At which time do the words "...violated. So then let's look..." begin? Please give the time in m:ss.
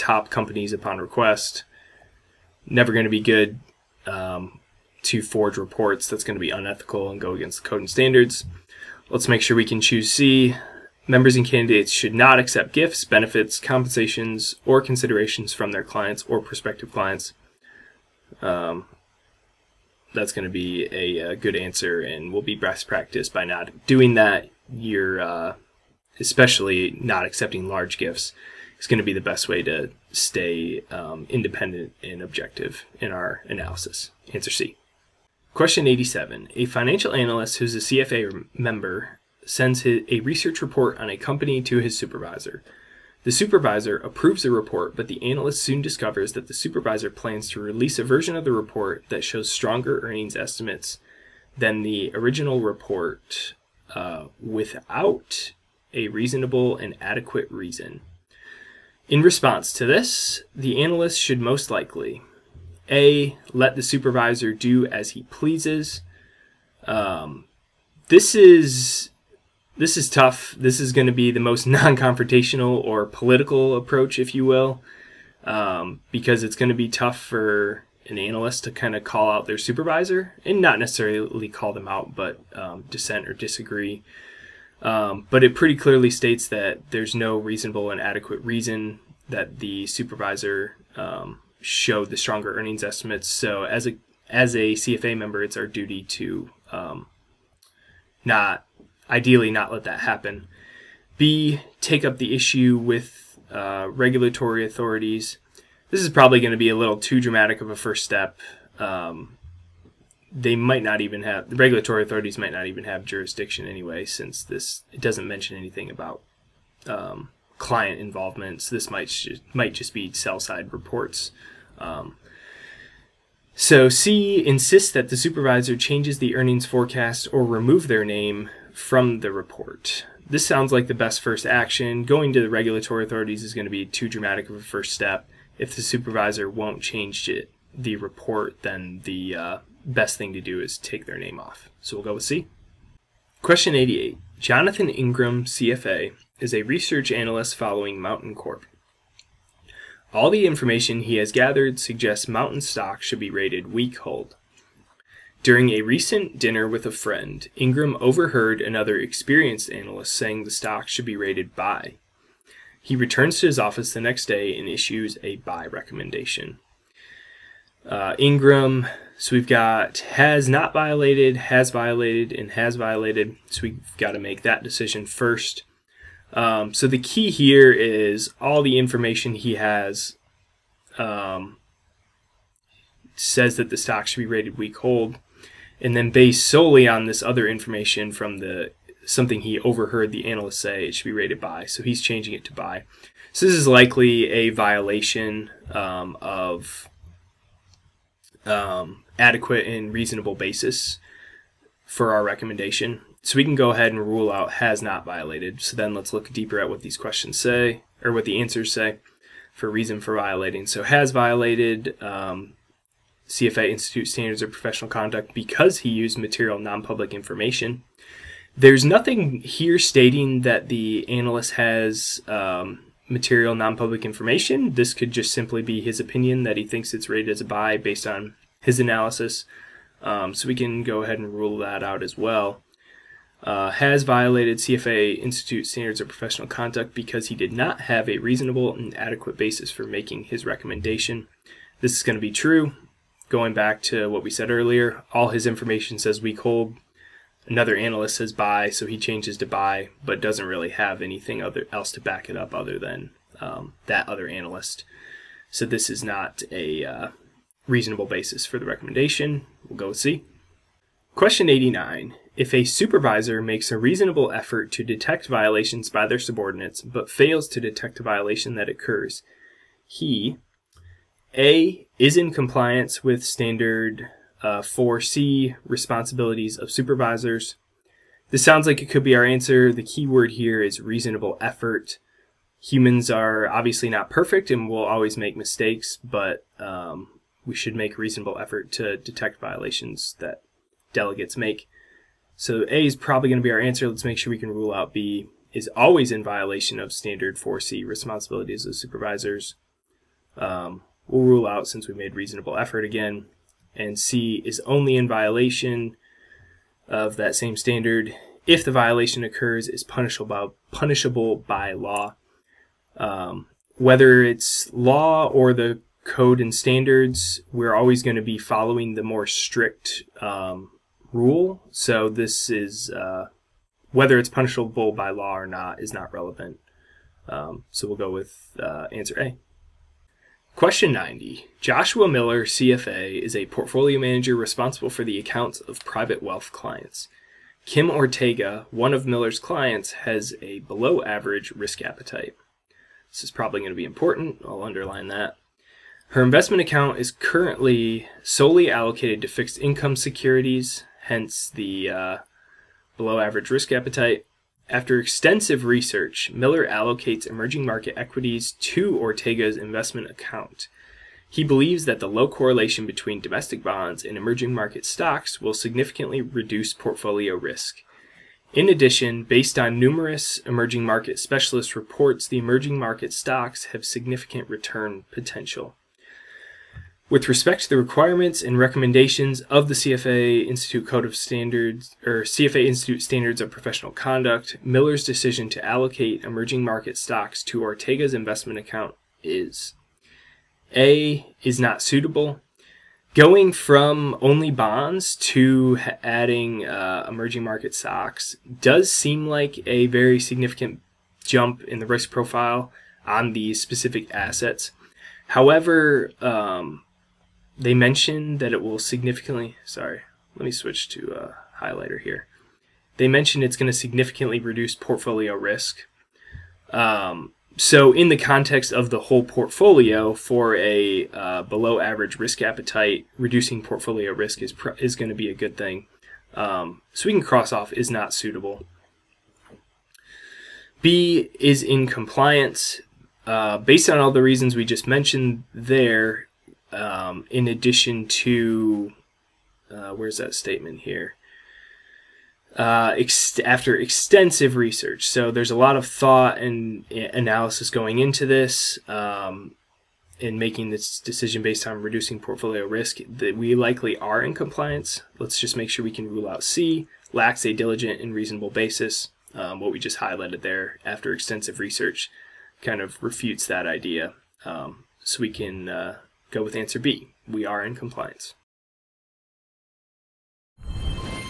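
3:25.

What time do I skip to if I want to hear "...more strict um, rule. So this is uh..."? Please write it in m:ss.
5:19.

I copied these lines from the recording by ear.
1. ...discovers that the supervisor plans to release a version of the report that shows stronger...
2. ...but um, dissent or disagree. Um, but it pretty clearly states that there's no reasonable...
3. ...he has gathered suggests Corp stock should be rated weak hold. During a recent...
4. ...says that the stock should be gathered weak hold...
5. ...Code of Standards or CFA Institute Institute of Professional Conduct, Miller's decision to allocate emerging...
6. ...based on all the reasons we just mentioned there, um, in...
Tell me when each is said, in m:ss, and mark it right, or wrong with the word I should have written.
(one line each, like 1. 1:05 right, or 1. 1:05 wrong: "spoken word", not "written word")
1. 0:45 right
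2. 1:22 right
3. 2:31 wrong: "Mountain", not "Corp"
4. 3:03 wrong: "rated", not "gathered"
5. 6:20 wrong: "Standards", not "Institute"
6. 7:13 right.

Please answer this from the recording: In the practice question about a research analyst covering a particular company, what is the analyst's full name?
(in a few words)
Jonathan Ingram.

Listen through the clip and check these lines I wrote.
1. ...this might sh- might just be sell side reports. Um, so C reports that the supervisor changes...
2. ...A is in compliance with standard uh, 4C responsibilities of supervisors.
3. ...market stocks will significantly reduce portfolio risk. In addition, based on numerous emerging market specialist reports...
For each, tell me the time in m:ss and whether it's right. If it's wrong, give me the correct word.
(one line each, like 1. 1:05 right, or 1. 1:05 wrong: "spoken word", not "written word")
1. 1:58 wrong: "insists", not "reports"
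2. 4:31 right
3. 6:04 right.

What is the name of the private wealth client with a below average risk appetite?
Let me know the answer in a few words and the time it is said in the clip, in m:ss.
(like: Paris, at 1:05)
Kim Ortega, at 5:37.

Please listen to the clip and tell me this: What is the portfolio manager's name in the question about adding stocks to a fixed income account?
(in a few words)
Joshua Miller.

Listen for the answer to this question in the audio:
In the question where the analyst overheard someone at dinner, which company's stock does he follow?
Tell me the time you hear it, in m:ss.
2:27.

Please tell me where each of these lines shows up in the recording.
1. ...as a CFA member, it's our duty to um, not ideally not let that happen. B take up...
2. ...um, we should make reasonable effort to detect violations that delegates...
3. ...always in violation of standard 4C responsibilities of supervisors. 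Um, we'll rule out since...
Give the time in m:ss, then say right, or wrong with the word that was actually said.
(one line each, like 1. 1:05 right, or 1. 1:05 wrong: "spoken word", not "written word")
1. 1:34 right
2. 4:46 right
3. 4:55 right.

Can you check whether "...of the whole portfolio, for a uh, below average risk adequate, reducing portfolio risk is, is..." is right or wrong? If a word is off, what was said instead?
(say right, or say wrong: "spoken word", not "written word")
wrong: "appetite", not "adequate".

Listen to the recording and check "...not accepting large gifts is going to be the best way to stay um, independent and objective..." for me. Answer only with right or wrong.
right.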